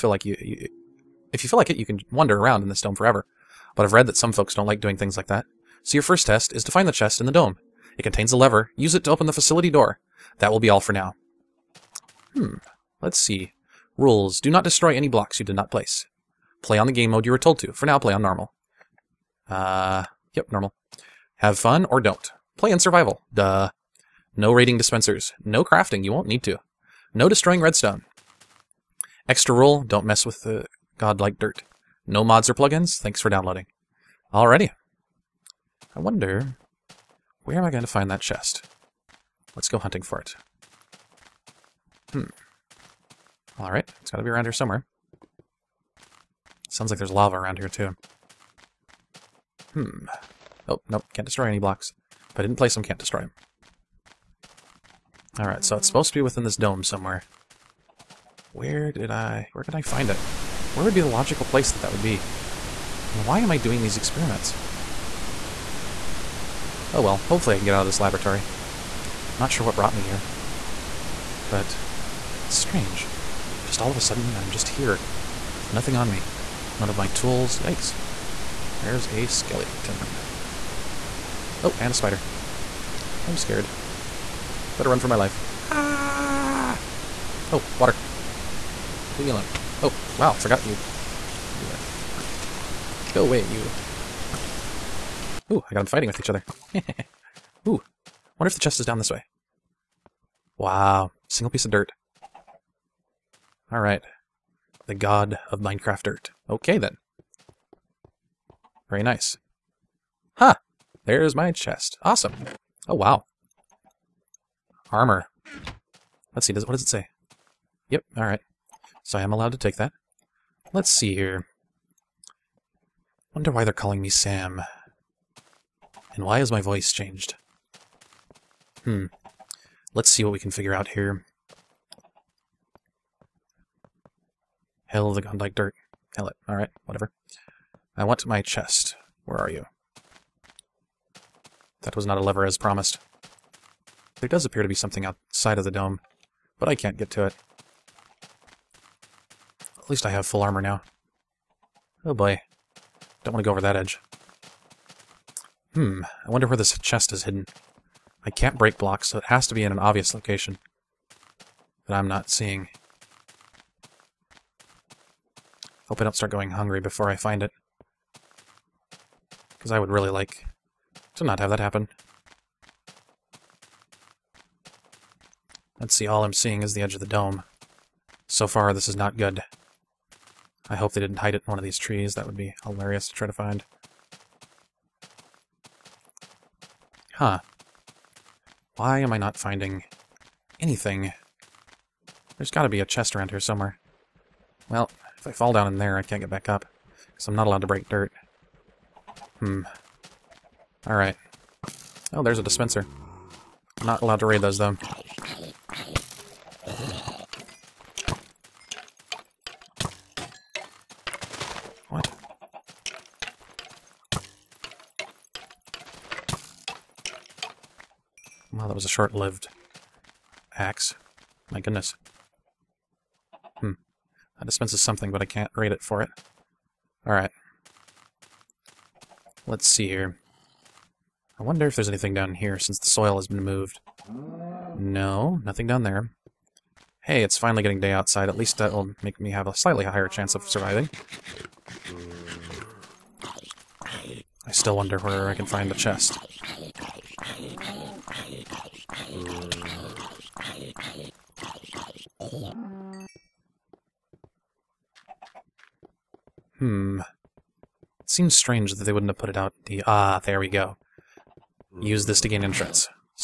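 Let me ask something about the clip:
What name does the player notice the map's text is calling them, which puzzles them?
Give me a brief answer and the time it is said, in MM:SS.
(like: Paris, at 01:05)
Sam, at 02:04.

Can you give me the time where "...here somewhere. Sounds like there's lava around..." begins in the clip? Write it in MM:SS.
00:44.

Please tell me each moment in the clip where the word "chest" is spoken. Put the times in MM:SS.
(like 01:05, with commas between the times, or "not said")
00:06, 00:38, 01:38, 01:51, 02:18, 02:36, 03:12, 04:05.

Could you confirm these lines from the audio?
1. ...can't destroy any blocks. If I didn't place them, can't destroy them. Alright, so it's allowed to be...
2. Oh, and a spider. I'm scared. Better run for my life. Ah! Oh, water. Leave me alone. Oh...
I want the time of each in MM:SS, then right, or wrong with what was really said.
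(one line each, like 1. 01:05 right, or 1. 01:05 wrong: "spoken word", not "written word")
1. 00:51 wrong: "supposed", not "allowed"
2. 01:21 right.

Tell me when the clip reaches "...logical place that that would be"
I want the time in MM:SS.
01:01.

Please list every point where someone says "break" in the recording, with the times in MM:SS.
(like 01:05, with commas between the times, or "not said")
02:38, 03:17.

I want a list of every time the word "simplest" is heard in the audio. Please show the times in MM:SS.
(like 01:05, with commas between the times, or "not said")
not said.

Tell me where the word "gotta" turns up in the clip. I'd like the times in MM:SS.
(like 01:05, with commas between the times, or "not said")
00:44, 03:12.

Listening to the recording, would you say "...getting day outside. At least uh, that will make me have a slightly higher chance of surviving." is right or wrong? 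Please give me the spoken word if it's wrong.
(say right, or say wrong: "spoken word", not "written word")
right.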